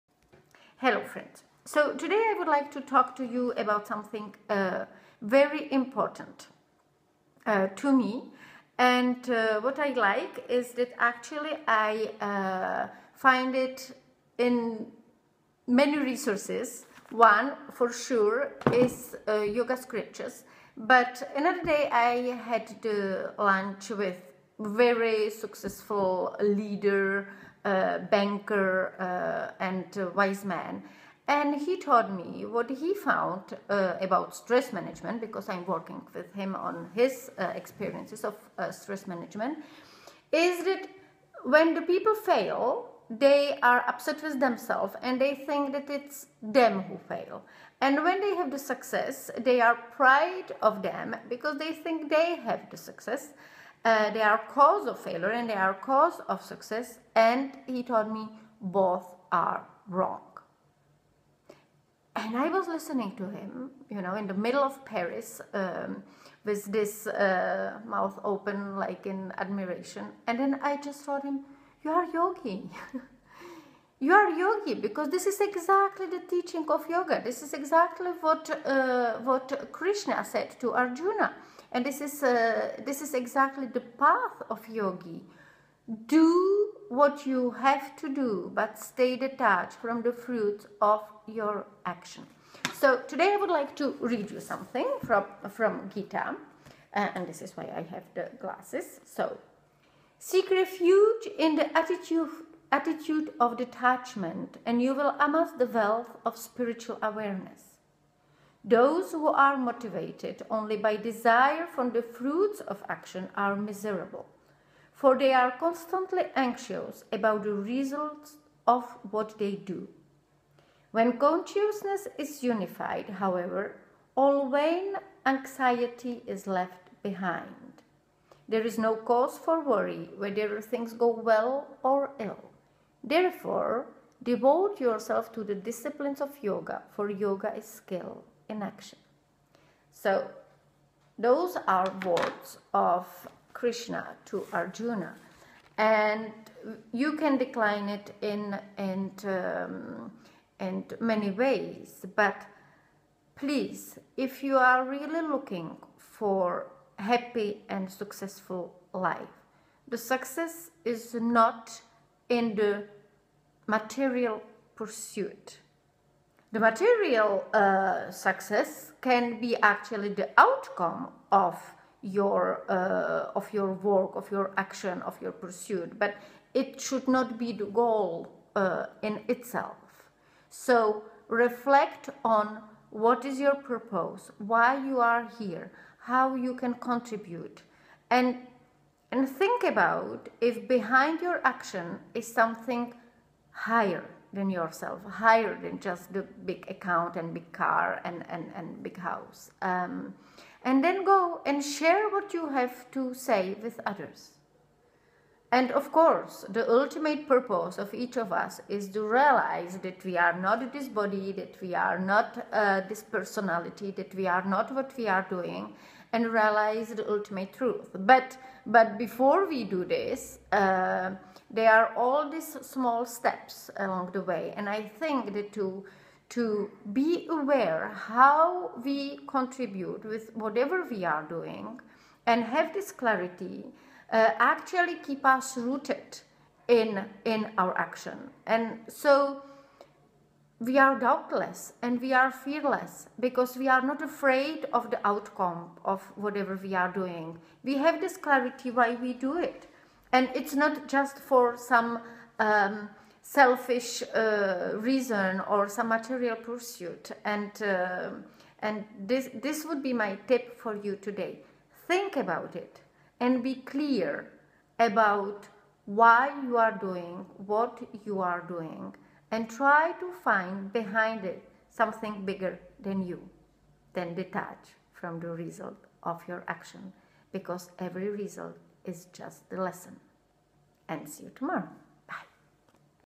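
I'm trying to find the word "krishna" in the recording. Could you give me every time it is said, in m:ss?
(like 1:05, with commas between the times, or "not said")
1:19, 2:23.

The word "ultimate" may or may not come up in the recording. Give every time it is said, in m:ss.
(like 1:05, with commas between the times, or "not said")
3:26, 3:37.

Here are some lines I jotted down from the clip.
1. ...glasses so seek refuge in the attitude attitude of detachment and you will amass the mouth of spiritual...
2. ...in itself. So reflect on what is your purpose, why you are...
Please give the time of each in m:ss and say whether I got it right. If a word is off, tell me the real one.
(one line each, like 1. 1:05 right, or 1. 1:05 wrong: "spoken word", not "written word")
1. 1:38 wrong: "wealth", not "mouth"
2. 2:59 right.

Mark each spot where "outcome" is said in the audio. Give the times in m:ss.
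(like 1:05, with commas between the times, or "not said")
2:50, 4:05.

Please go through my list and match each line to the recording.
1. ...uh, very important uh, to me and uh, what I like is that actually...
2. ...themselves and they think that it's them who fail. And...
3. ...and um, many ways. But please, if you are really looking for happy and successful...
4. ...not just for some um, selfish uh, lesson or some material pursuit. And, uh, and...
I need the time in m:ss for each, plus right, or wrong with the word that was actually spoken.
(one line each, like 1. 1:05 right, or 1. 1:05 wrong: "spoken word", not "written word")
1. 0:04 right
2. 0:44 right
3. 2:28 right
4. 4:10 wrong: "reason", not "lesson".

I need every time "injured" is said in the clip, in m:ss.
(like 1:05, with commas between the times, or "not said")
not said.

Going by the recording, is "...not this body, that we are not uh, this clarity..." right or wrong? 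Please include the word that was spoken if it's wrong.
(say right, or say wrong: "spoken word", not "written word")
wrong: "personality", not "clarity".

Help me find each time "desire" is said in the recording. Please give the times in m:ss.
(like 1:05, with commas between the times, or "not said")
1:50.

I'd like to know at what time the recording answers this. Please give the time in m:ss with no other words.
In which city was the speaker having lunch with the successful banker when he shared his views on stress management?
1:04.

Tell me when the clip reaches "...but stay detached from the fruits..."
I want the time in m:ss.
1:28.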